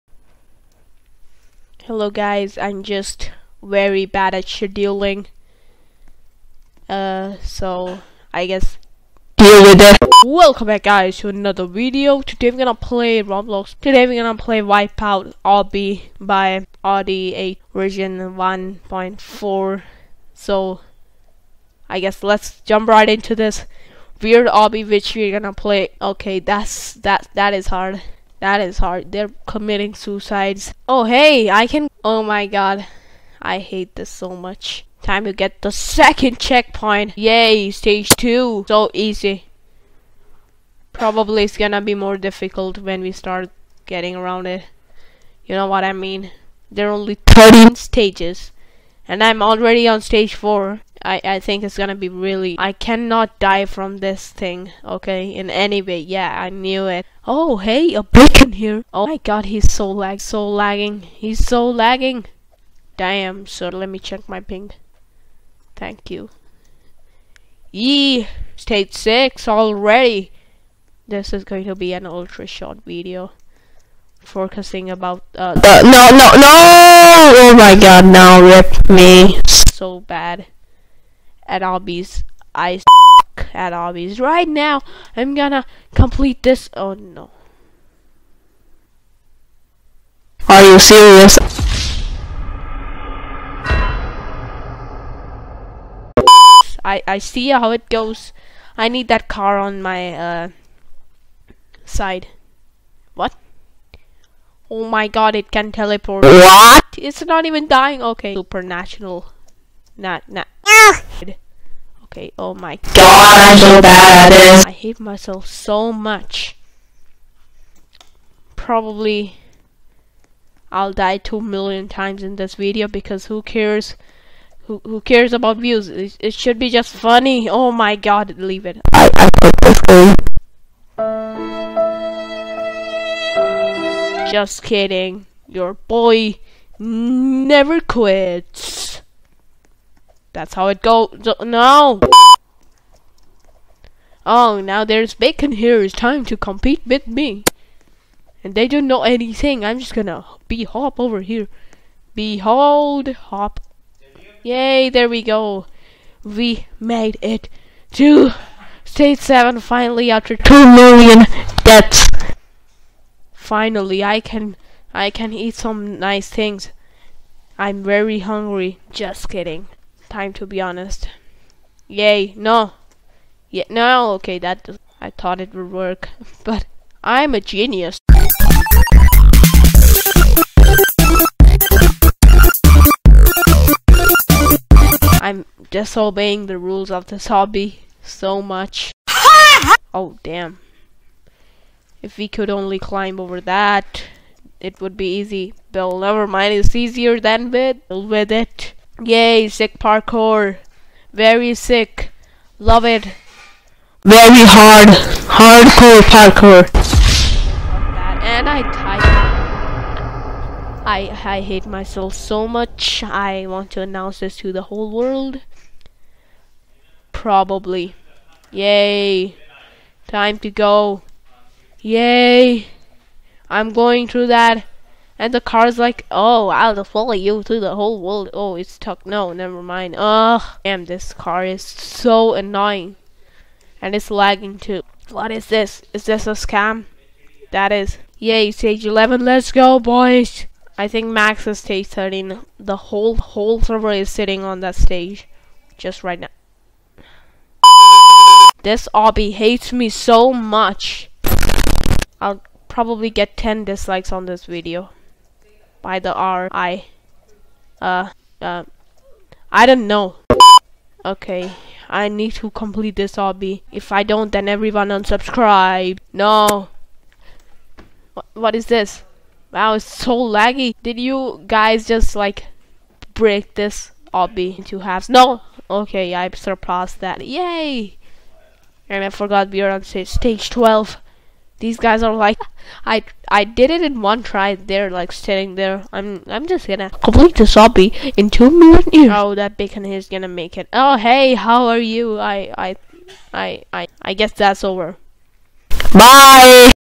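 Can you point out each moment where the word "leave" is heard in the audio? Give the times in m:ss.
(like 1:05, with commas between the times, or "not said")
2:08.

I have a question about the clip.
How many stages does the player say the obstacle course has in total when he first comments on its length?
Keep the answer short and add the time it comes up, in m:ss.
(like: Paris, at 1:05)
13, at 0:47.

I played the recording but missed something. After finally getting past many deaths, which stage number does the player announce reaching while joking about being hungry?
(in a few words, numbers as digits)
7.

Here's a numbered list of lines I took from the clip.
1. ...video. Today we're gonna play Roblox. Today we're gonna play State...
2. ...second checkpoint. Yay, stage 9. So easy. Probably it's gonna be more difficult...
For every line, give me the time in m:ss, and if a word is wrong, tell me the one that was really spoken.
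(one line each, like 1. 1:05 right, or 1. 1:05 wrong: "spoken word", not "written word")
1. 0:11 wrong: "Wipeout", not "State"
2. 0:35 wrong: "2", not "9".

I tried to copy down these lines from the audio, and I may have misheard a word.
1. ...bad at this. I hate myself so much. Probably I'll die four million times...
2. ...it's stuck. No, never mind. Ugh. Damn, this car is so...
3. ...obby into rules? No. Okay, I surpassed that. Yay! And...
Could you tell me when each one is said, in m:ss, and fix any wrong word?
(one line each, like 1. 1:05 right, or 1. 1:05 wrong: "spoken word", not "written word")
1. 1:53 wrong: "two", not "four"
2. 3:48 right
3. 4:34 wrong: "halves", not "rules".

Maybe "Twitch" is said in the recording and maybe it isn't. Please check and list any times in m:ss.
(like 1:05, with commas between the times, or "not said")
not said.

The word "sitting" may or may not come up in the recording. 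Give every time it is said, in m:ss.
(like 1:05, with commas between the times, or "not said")
4:04, 4:45.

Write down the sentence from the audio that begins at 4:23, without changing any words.
If I don't, then everyone unsubscribe.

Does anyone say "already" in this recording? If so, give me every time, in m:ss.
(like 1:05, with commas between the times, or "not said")
0:49, 1:09.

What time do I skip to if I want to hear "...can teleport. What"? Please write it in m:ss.
1:45.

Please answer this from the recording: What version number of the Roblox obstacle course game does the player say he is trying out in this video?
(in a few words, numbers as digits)
1.4.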